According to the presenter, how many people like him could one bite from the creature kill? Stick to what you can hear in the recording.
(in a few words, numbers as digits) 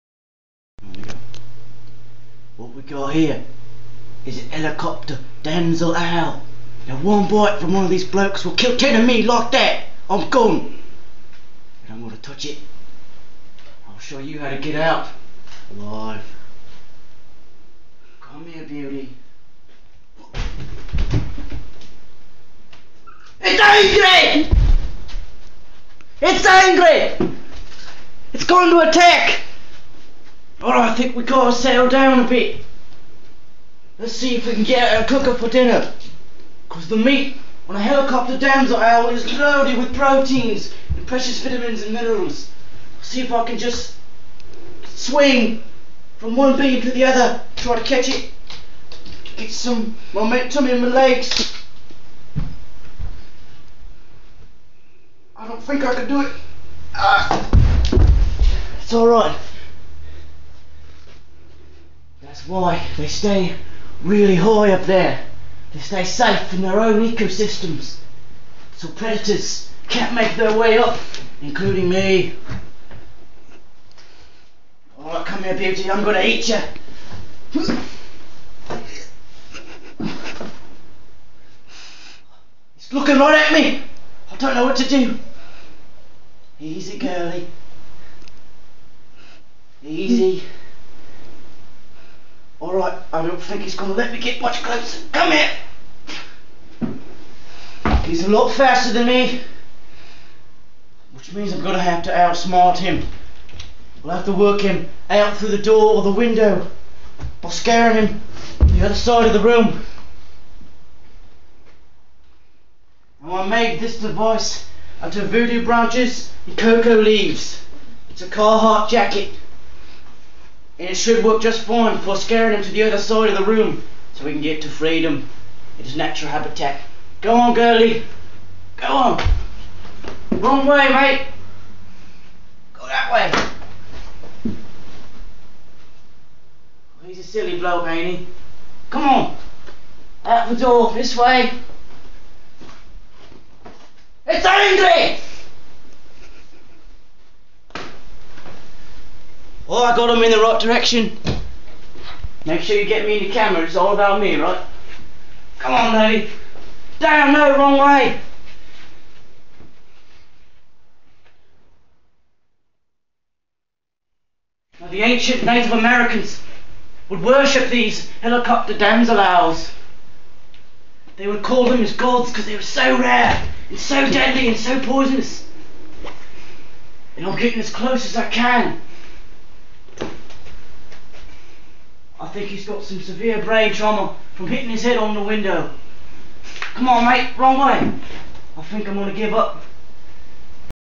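10.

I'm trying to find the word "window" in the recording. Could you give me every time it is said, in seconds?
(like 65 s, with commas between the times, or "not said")
106 s, 185 s.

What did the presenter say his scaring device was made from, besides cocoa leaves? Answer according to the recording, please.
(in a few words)
Voodoo branches.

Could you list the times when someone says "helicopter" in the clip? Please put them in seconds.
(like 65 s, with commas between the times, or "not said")
4 s, 37 s, 168 s.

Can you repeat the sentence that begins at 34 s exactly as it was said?
Let's see if we can get a cooker for dinner.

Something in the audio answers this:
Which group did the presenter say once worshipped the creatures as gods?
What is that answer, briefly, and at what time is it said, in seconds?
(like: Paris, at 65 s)
Ancient Native Americans, at 165 s.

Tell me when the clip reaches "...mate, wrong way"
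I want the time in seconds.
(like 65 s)
187 s.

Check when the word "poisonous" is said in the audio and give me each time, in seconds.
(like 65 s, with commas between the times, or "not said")
174 s.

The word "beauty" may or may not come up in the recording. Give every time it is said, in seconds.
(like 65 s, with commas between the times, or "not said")
18 s, 75 s.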